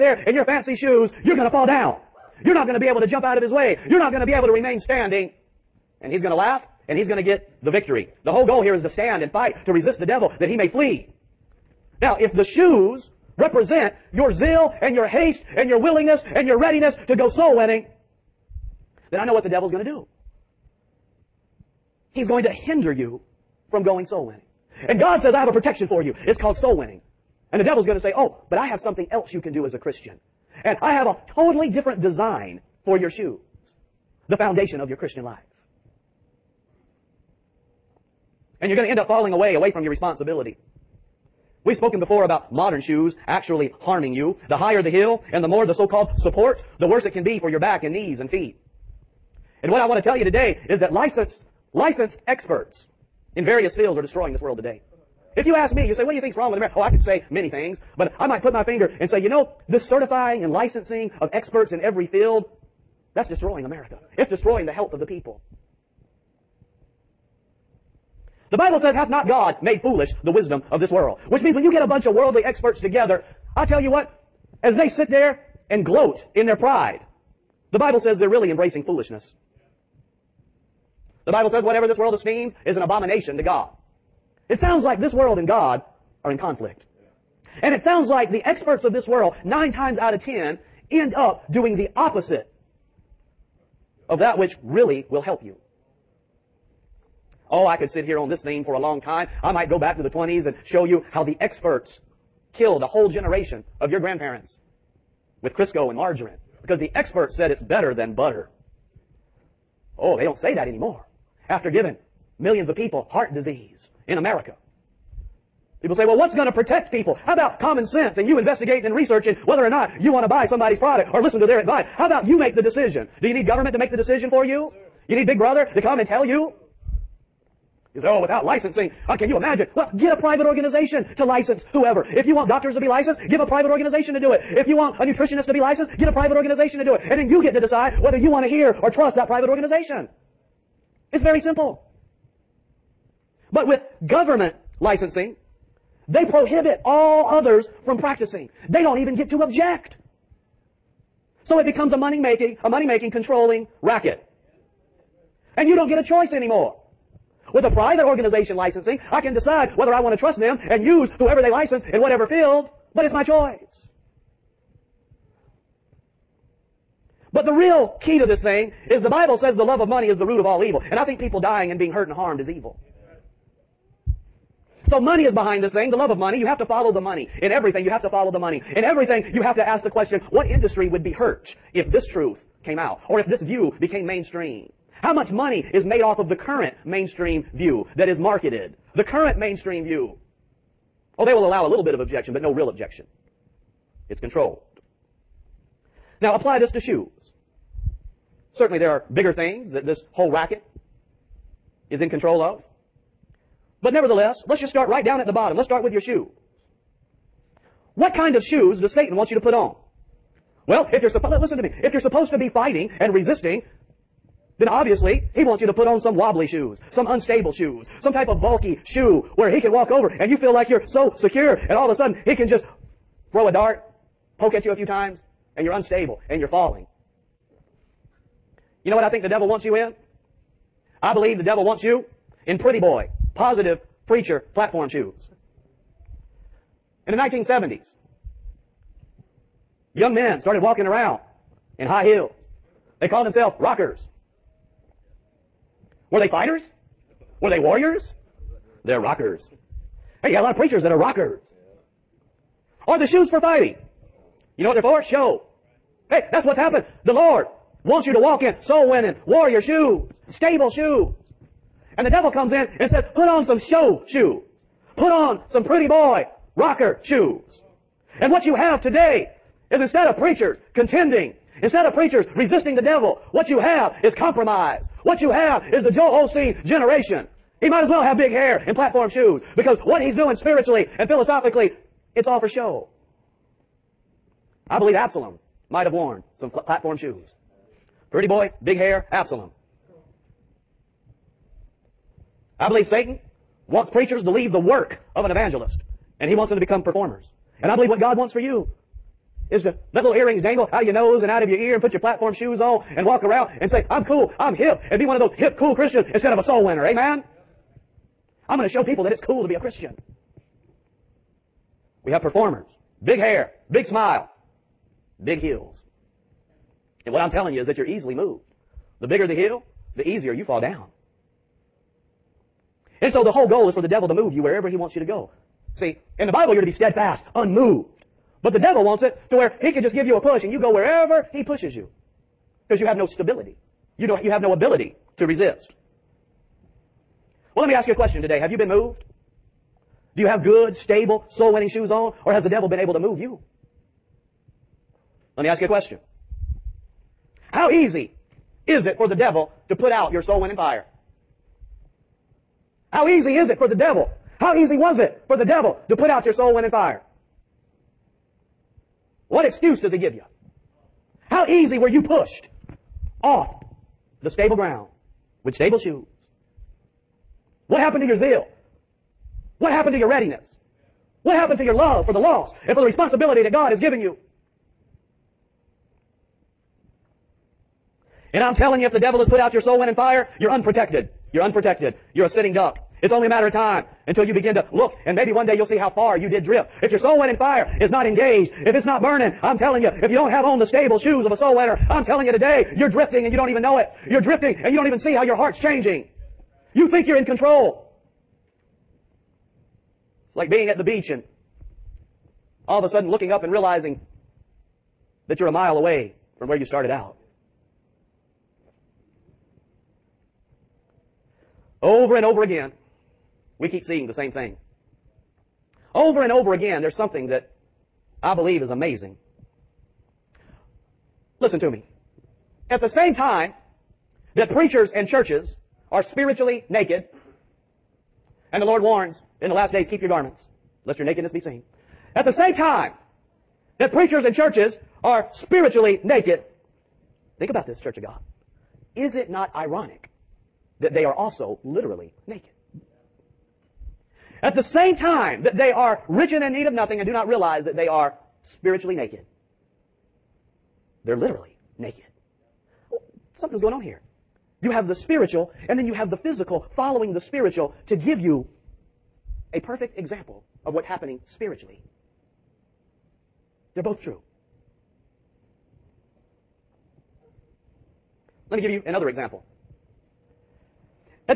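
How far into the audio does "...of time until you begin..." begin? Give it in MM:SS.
06:23.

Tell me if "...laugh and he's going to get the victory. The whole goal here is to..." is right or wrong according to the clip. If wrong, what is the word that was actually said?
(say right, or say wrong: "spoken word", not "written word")
right.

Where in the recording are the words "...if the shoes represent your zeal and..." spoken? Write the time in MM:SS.
00:12.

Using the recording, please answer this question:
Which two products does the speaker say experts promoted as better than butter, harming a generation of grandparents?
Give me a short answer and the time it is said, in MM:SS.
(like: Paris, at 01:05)
Crisco and margarine, at 01:45.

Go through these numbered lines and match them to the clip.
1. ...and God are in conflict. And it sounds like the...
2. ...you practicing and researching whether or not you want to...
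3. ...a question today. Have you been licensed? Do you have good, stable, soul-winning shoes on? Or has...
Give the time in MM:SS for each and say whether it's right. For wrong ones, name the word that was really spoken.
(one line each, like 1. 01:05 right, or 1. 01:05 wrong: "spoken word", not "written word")
1. 01:25 right
2. 01:58 wrong: "investigating", not "practicing"
3. 05:37 wrong: "moved", not "licensed".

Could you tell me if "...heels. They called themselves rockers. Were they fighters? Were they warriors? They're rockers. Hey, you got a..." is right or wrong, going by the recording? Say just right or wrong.
right.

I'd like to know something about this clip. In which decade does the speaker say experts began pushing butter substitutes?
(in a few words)
1920s.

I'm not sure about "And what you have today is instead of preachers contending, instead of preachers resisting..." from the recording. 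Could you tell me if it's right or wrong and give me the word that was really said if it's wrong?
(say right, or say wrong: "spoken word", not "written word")
right.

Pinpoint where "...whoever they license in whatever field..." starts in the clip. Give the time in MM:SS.
02:41.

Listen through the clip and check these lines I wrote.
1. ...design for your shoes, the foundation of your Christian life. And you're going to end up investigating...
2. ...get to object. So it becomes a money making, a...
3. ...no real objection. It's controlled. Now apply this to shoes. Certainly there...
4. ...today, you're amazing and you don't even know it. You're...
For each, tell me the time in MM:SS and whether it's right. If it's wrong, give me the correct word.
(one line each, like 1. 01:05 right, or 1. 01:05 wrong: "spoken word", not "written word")
1. 00:32 wrong: "falling", not "investigating"
2. 02:29 right
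3. 03:12 right
4. 06:32 wrong: "drifting", not "amazing".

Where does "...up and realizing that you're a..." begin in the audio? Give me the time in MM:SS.
06:43.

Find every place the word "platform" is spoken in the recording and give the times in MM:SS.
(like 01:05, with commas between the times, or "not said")
03:54, 04:38, 04:46, 05:01.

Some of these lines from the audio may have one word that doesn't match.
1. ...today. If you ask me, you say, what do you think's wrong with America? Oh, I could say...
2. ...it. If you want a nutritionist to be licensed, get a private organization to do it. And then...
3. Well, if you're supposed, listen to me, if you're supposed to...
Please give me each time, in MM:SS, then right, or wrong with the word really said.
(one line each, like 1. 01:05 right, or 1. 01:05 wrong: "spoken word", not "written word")
1. 00:54 right
2. 02:14 right
3. 03:30 right.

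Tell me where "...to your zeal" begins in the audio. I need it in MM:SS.
06:08.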